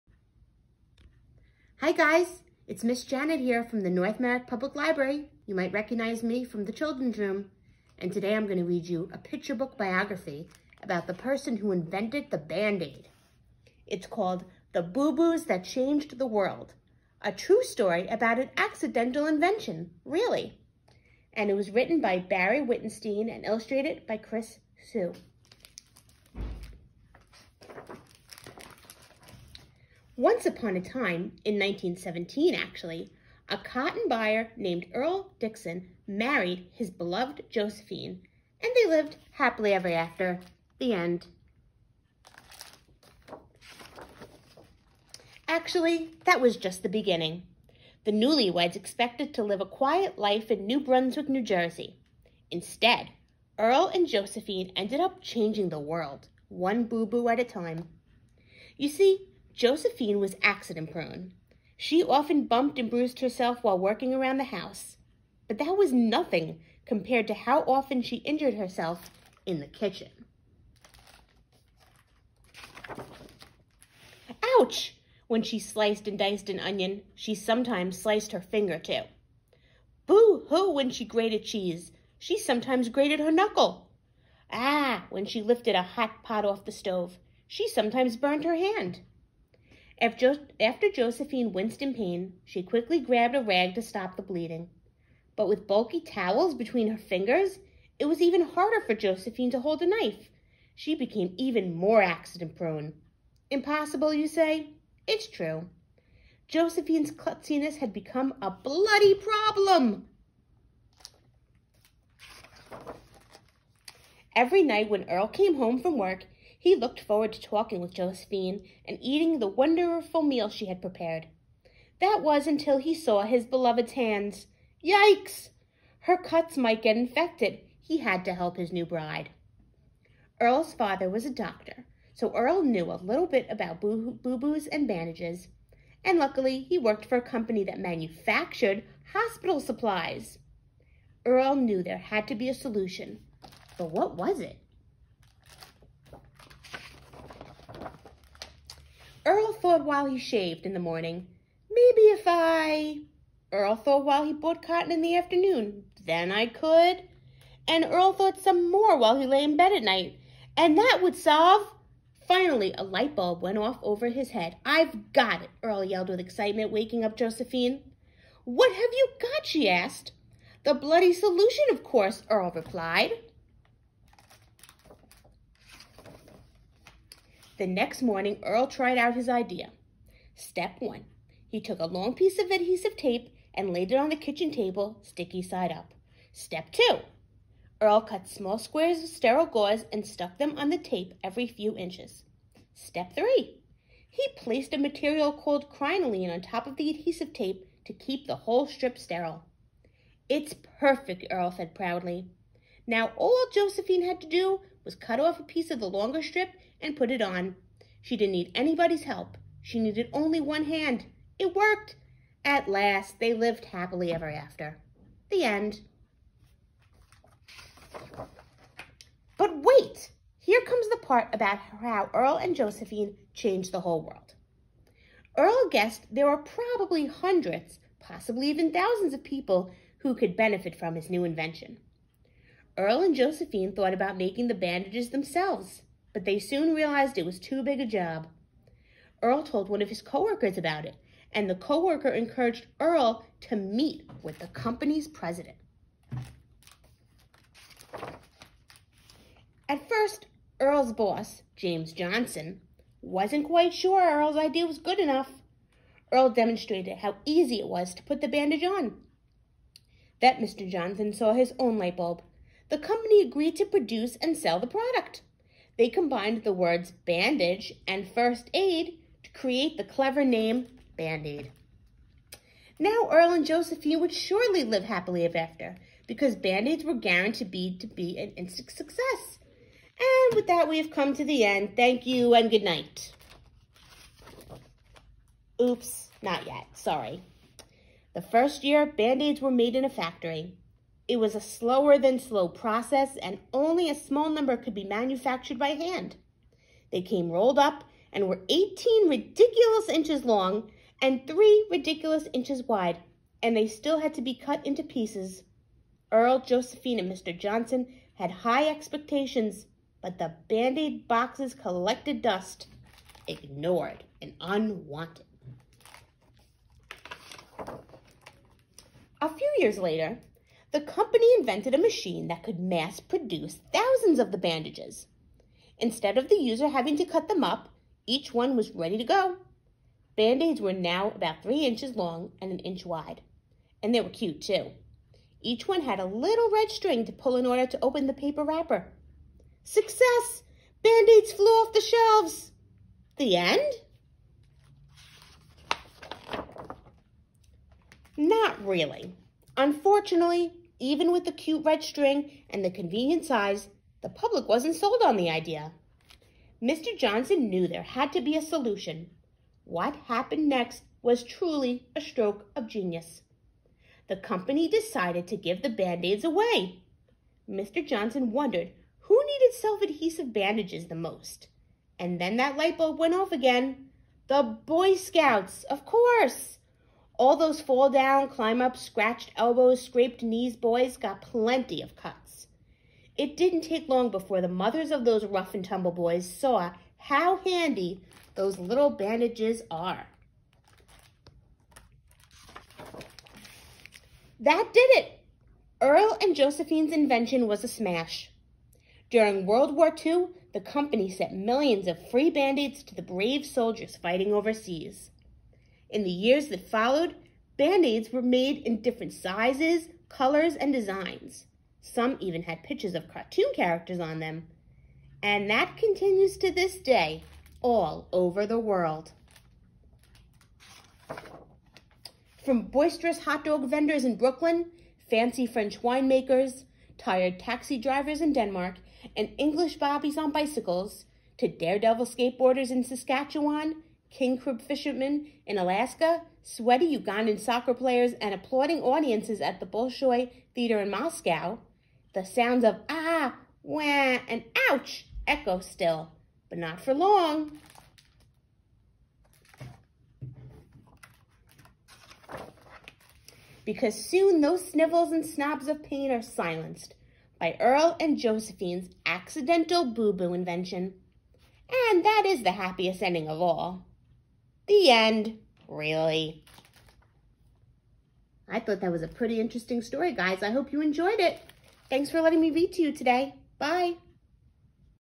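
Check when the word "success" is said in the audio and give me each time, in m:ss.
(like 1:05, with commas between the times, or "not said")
4:38, 5:39.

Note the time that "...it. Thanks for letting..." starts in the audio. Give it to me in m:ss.
7:51.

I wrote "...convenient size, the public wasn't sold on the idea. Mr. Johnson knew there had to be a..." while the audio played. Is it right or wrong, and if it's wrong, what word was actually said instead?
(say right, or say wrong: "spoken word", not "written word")
right.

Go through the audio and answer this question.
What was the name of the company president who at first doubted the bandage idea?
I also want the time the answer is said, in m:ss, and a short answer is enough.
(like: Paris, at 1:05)
James Johnson, at 4:11.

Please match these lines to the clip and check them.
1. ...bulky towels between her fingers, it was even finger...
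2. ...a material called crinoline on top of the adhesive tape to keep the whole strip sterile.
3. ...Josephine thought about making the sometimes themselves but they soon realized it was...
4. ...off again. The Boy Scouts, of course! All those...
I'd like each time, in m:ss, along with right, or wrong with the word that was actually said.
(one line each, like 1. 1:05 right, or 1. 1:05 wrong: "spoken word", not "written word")
1. 1:35 wrong: "harder", not "finger"
2. 3:14 right
3. 3:53 wrong: "bandages", not "sometimes"
4. 6:13 right.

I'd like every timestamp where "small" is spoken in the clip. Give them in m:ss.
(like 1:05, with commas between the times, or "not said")
3:08, 4:53.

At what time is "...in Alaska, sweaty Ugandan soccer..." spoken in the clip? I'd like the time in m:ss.
7:15.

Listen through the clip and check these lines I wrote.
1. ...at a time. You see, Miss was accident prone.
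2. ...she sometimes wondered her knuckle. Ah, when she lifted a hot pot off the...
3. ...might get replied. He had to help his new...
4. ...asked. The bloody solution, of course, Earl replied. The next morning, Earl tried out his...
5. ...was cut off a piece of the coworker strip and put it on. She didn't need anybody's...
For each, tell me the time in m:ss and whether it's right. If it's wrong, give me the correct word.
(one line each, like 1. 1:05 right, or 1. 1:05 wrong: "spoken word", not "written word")
1. 0:57 wrong: "Josephine", not "Miss"
2. 1:22 wrong: "grated", not "wondered"
3. 2:06 wrong: "infected", not "replied"
4. 2:49 right
5. 3:24 wrong: "longer", not "coworker".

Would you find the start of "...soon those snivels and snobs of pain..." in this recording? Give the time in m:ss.
7:33.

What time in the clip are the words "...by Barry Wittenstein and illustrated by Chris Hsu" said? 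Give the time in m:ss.
0:21.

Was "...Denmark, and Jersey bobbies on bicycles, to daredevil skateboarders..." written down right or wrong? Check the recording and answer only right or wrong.
wrong.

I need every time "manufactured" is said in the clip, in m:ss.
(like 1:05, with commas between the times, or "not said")
2:17, 4:54.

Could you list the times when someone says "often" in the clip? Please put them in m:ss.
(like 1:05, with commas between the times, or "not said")
1:02, 1:07.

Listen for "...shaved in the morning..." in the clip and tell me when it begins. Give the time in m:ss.
2:30.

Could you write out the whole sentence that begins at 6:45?
In the years that followed, Band-Aids were made in different sizes, colors, and designs.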